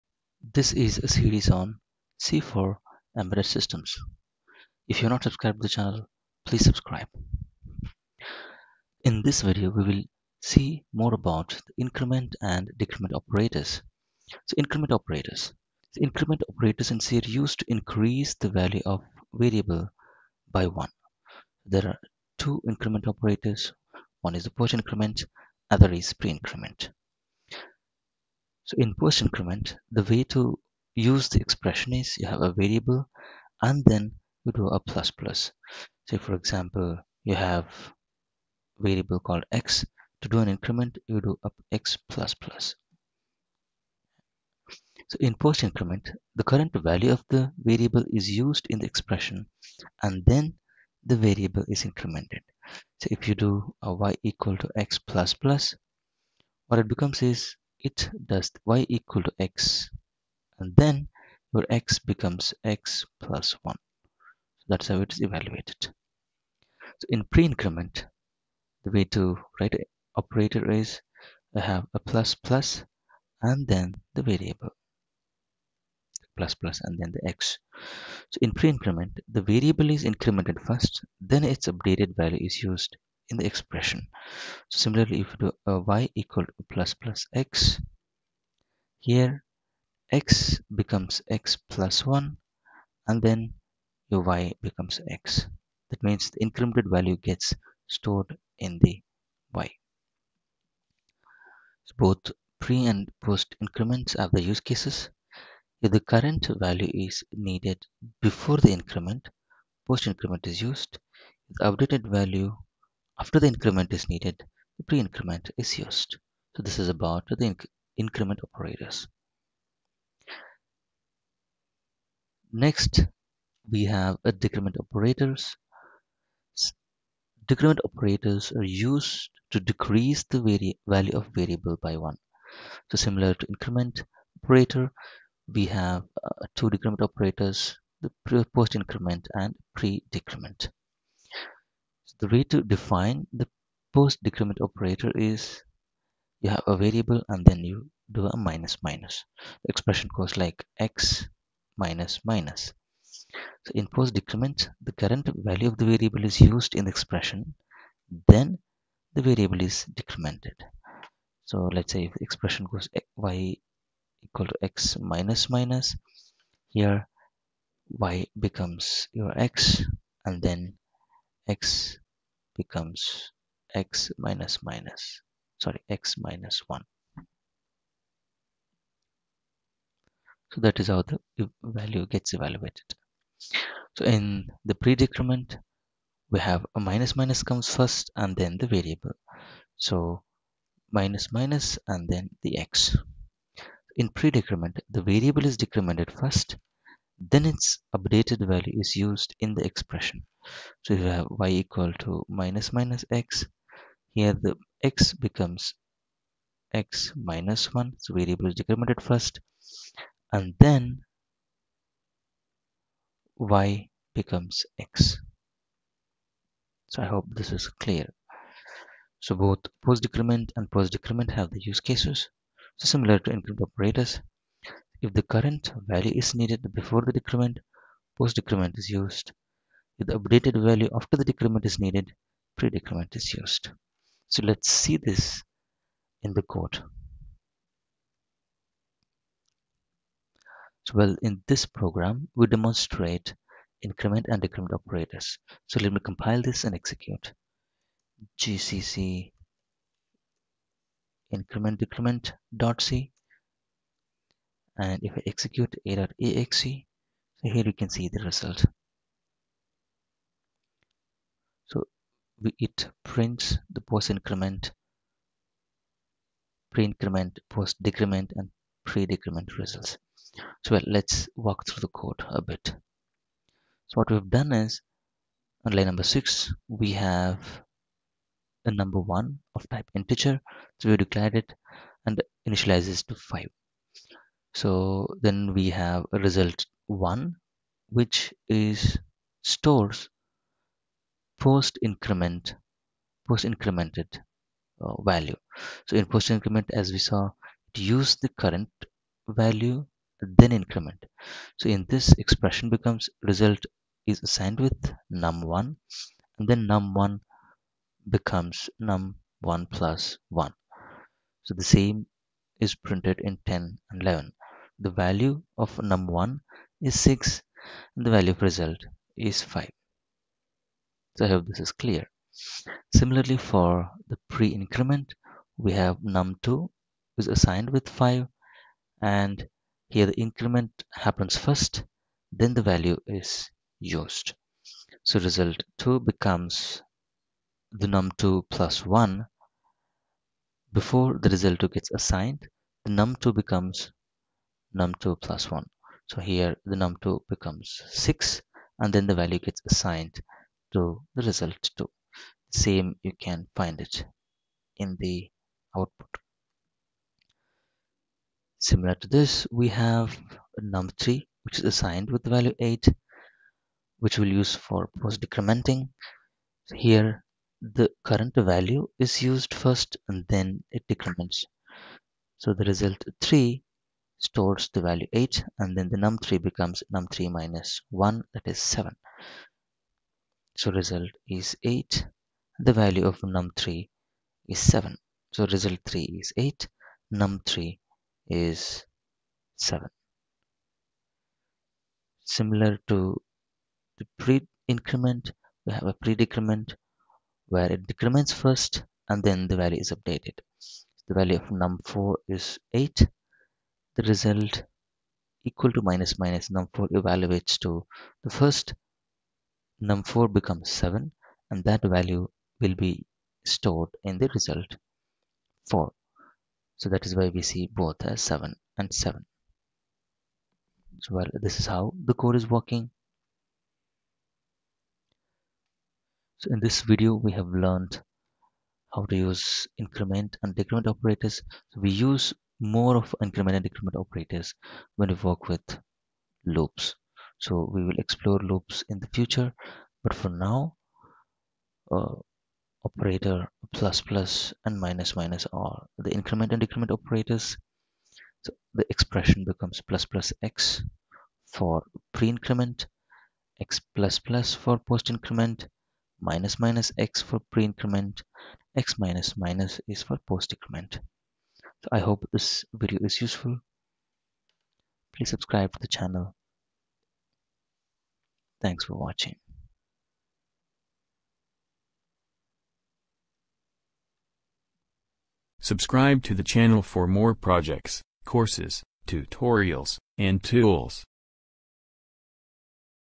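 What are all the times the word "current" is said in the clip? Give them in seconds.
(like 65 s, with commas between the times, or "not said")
46 s, 106 s, 154 s, 225 s, 298 s, 368 s.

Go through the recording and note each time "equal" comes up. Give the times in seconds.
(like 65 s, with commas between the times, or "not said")
54 s, 58 s, 86 s, 164 s, 201 s, 405 s.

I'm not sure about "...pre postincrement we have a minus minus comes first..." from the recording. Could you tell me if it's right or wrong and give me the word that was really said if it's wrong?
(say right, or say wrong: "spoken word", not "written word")
wrong: "decrement", not "postincrement".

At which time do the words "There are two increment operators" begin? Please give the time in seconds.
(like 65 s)
21 s.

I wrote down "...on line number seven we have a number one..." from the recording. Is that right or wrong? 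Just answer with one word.
wrong.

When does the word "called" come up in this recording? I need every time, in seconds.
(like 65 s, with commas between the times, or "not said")
39 s.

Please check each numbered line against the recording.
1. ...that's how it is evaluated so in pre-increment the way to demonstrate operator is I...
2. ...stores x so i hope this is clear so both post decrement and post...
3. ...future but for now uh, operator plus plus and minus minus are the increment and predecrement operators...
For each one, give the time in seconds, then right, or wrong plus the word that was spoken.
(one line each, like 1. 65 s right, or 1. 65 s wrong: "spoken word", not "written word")
1. 64 s wrong: "write", not "demonstrate"
2. 214 s wrong: "becomes", not "stores"
3. 439 s wrong: "decrement", not "predecrement".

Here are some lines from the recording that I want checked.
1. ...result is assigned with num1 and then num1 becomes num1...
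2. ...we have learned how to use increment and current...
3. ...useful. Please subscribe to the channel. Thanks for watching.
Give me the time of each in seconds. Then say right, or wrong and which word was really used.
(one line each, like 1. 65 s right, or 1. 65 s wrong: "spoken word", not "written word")
1. 303 s right
2. 427 s wrong: "decrement", not "current"
3. 463 s right.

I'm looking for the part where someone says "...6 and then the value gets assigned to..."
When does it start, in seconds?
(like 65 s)
347 s.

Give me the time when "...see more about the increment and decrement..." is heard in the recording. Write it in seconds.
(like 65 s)
10 s.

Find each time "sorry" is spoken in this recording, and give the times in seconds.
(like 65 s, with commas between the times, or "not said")
175 s.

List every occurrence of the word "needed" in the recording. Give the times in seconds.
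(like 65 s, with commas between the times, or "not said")
107 s, 114 s, 226 s, 231 s.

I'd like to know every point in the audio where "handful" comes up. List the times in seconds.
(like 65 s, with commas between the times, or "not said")
not said.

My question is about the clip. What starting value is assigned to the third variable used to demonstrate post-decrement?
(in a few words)
8.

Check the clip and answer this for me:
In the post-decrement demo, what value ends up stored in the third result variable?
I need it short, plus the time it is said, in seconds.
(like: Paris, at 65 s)
8, at 385 s.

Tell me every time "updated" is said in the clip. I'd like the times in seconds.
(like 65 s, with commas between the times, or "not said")
81 s, 111 s, 197 s, 230 s, 399 s.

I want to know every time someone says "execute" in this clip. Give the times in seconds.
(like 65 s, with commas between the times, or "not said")
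246 s, 255 s.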